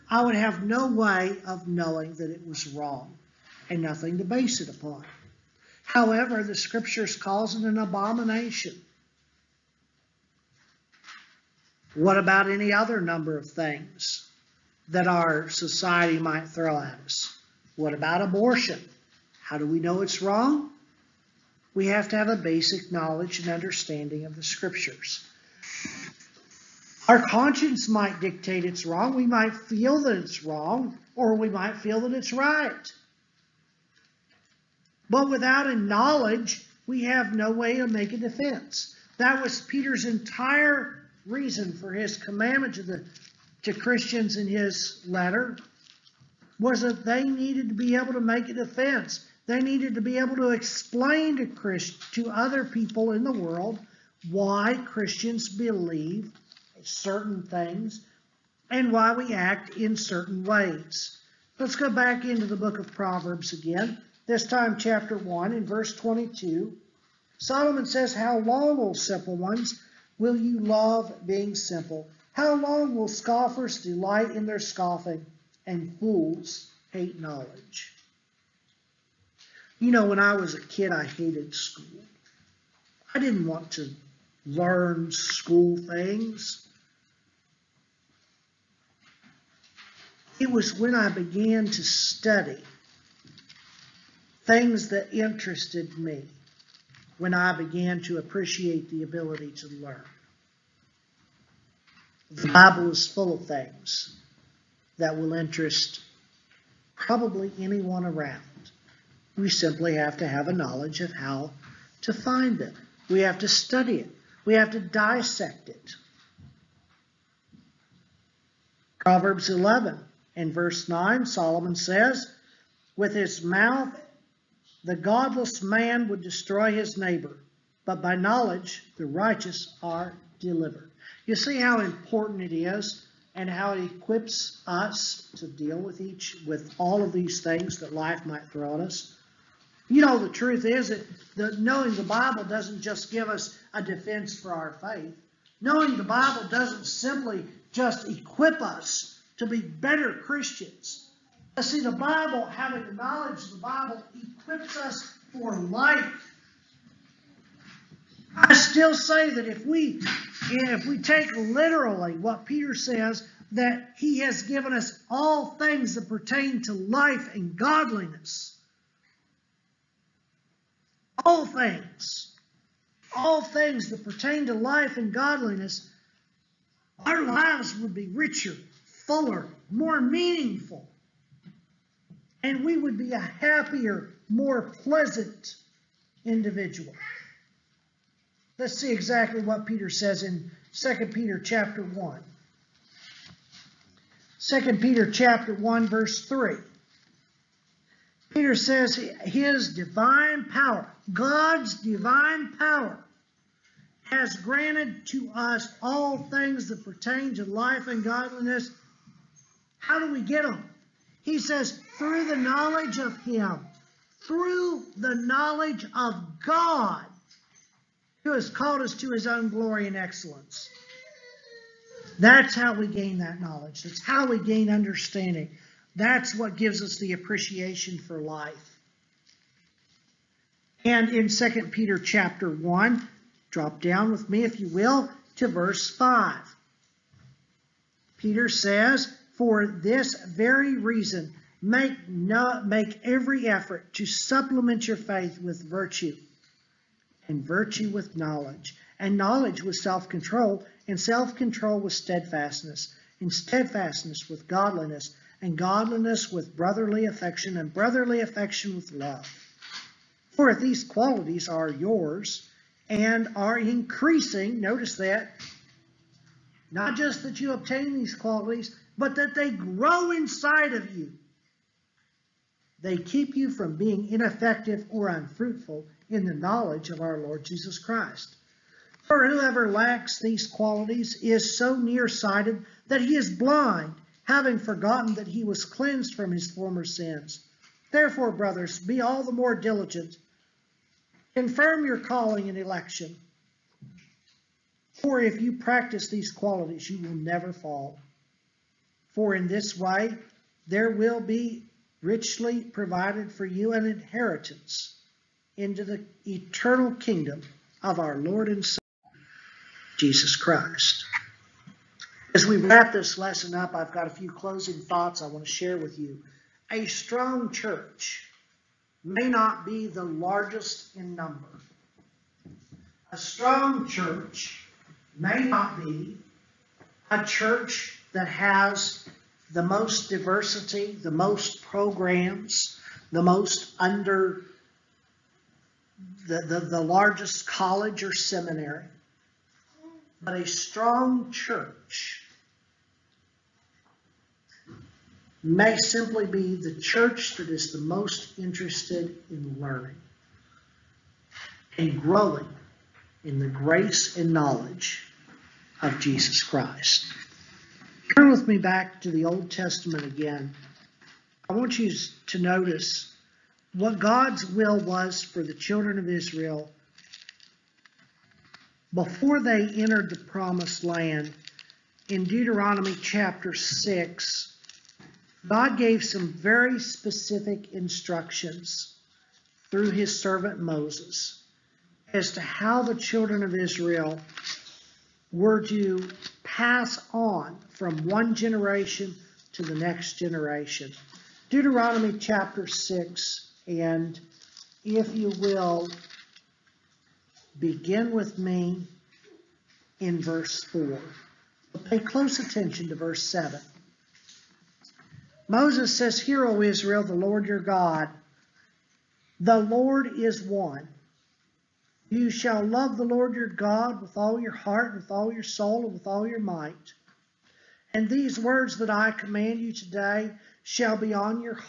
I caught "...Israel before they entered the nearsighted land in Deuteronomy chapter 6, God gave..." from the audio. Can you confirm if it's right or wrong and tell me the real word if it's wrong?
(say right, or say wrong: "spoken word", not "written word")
wrong: "promised", not "nearsighted".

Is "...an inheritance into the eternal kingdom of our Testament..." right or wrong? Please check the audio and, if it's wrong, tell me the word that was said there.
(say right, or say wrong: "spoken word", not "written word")
wrong: "Lord", not "Testament".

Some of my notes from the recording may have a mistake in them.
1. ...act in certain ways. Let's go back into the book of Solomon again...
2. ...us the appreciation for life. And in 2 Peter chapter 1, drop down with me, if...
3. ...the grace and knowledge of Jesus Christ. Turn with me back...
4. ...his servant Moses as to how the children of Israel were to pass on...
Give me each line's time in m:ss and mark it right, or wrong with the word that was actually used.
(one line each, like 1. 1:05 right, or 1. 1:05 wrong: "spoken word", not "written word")
1. 0:59 wrong: "Proverbs", not "Solomon"
2. 3:46 right
3. 5:53 right
4. 6:19 right.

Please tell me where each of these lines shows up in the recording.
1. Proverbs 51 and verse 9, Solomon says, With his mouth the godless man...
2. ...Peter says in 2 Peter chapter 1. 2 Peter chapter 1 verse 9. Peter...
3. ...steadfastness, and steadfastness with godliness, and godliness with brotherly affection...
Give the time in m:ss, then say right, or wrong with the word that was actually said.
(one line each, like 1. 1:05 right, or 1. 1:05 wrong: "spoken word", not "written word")
1. 1:58 wrong: "11", not "51"
2. 3:09 wrong: "3", not "9"
3. 4:11 right.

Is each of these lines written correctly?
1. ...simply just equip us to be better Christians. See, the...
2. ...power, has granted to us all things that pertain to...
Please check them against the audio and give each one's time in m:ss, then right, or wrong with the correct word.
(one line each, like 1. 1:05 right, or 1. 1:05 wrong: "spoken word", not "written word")
1. 2:26 right
2. 3:22 right.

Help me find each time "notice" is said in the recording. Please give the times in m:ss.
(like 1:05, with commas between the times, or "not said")
4:24, 6:02.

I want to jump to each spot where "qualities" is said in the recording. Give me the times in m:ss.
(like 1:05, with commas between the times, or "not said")
4:20, 4:28, 4:40, 4:56.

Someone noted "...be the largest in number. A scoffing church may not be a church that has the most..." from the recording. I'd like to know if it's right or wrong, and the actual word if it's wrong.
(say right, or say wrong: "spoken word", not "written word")
wrong: "strong", not "scoffing".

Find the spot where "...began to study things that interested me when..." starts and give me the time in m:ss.
1:31.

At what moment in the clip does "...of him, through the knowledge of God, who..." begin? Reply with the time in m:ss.
3:32.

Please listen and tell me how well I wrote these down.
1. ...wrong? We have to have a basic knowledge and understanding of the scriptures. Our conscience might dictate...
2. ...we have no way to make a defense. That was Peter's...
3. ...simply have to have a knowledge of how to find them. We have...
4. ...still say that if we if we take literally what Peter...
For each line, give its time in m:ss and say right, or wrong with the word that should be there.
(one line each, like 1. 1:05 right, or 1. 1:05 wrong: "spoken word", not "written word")
1. 0:20 right
2. 0:36 right
3. 1:49 right
4. 2:38 right.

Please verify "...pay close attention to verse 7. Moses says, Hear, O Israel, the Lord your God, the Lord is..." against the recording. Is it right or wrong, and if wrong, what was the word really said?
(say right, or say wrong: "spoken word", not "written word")
right.